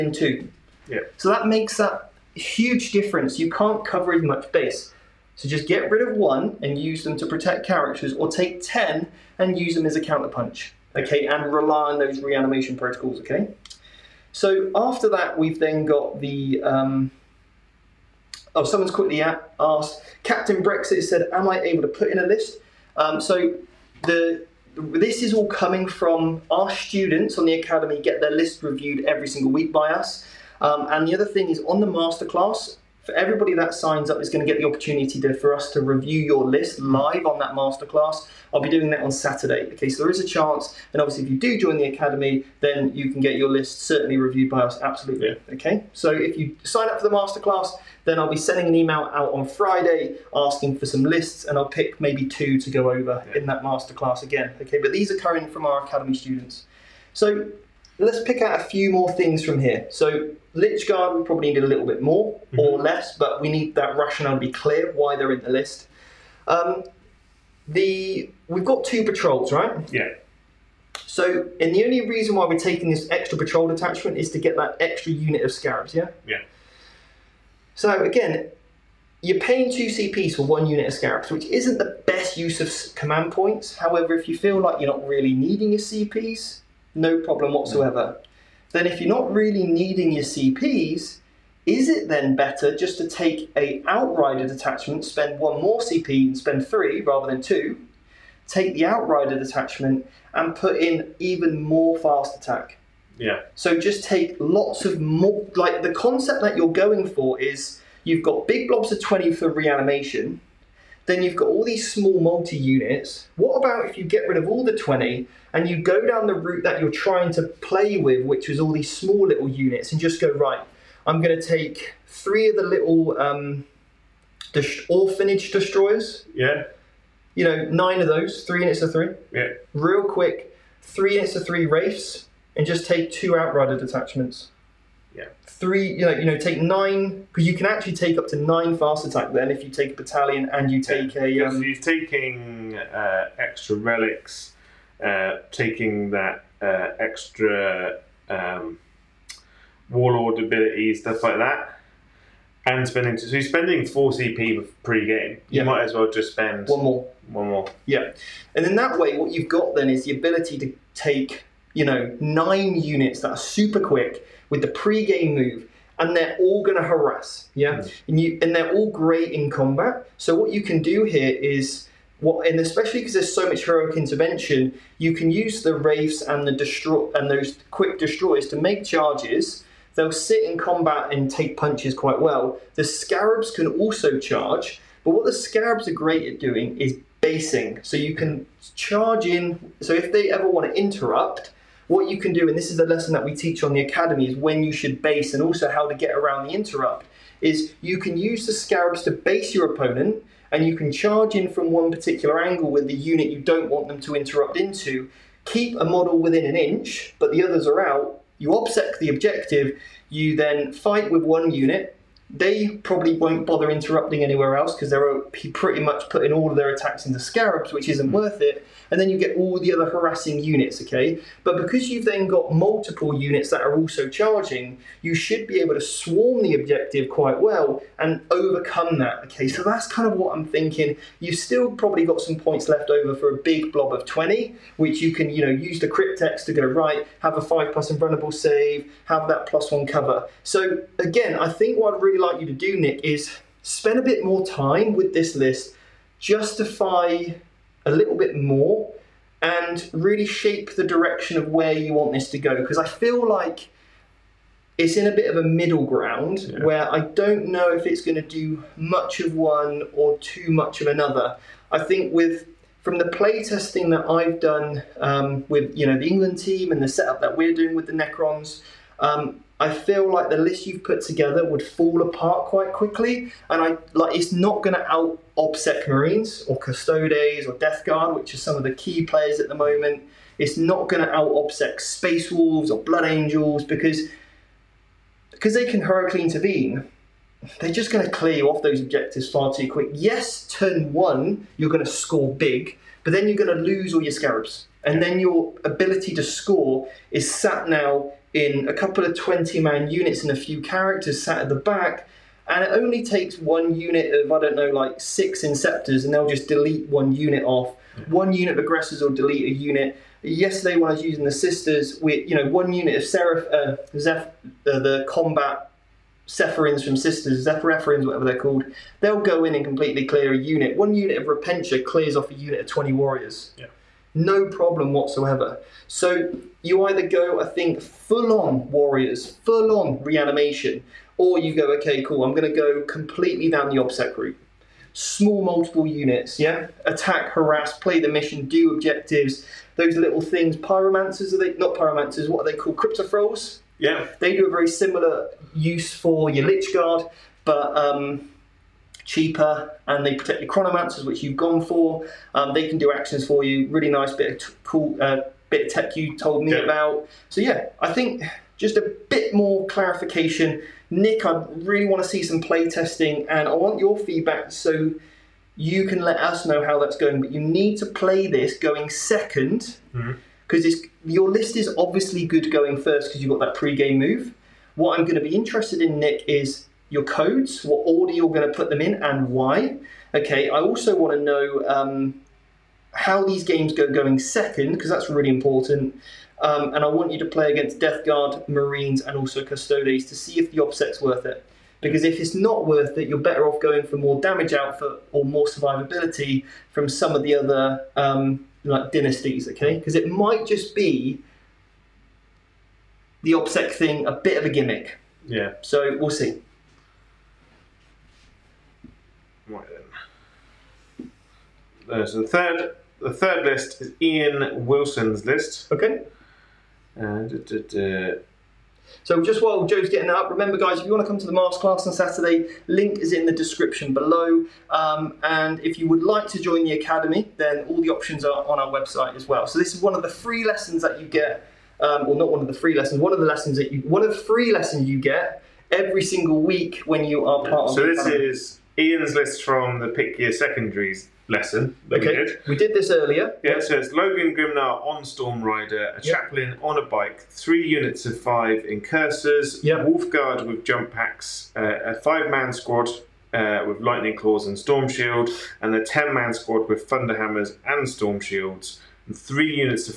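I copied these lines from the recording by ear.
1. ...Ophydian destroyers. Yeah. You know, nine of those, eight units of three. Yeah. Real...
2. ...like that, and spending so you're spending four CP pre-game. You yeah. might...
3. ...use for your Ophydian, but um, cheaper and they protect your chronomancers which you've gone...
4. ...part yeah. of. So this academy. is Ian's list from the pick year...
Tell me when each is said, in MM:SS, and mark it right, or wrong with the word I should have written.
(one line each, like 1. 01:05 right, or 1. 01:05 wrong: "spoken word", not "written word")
1. 02:04 wrong: "three", not "eight"
2. 02:31 right
3. 05:45 wrong: "Lychguard", not "Ophydian"
4. 07:17 right.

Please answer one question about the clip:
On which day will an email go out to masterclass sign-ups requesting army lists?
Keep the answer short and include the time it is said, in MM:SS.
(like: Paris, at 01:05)
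Friday, at 00:48.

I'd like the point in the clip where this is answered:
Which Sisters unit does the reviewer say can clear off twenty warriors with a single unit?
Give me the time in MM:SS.
05:20.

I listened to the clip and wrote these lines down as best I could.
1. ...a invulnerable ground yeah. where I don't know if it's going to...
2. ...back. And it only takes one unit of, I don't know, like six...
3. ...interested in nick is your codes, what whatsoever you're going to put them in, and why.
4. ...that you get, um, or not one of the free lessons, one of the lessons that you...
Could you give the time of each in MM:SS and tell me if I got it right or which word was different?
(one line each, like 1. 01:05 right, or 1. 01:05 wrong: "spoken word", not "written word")
1. 04:15 wrong: "middle", not "invulnerable"
2. 05:01 right
3. 06:15 wrong: "order", not "whatsoever"
4. 07:10 right.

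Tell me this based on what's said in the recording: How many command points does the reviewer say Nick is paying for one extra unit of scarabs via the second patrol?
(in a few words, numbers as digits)
2.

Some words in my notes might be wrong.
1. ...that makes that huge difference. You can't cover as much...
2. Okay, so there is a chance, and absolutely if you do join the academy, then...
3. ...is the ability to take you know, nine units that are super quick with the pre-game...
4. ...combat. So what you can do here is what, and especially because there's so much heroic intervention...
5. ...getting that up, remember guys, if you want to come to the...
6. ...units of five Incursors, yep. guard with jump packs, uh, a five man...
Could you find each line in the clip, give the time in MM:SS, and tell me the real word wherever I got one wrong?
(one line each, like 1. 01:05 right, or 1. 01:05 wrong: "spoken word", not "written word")
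1. 00:01 right
2. 00:39 wrong: "obviously", not "absolutely"
3. 02:39 right
4. 02:49 right
5. 06:59 right
6. 07:27 right.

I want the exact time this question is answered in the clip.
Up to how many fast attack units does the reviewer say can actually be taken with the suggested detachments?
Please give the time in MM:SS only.
02:17.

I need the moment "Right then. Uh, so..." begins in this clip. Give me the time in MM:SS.
06:49.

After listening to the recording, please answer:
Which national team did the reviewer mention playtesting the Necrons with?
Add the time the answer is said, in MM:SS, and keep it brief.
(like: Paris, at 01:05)
England team, at 04:25.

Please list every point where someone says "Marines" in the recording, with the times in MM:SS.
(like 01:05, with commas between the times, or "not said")
04:35, 06:28.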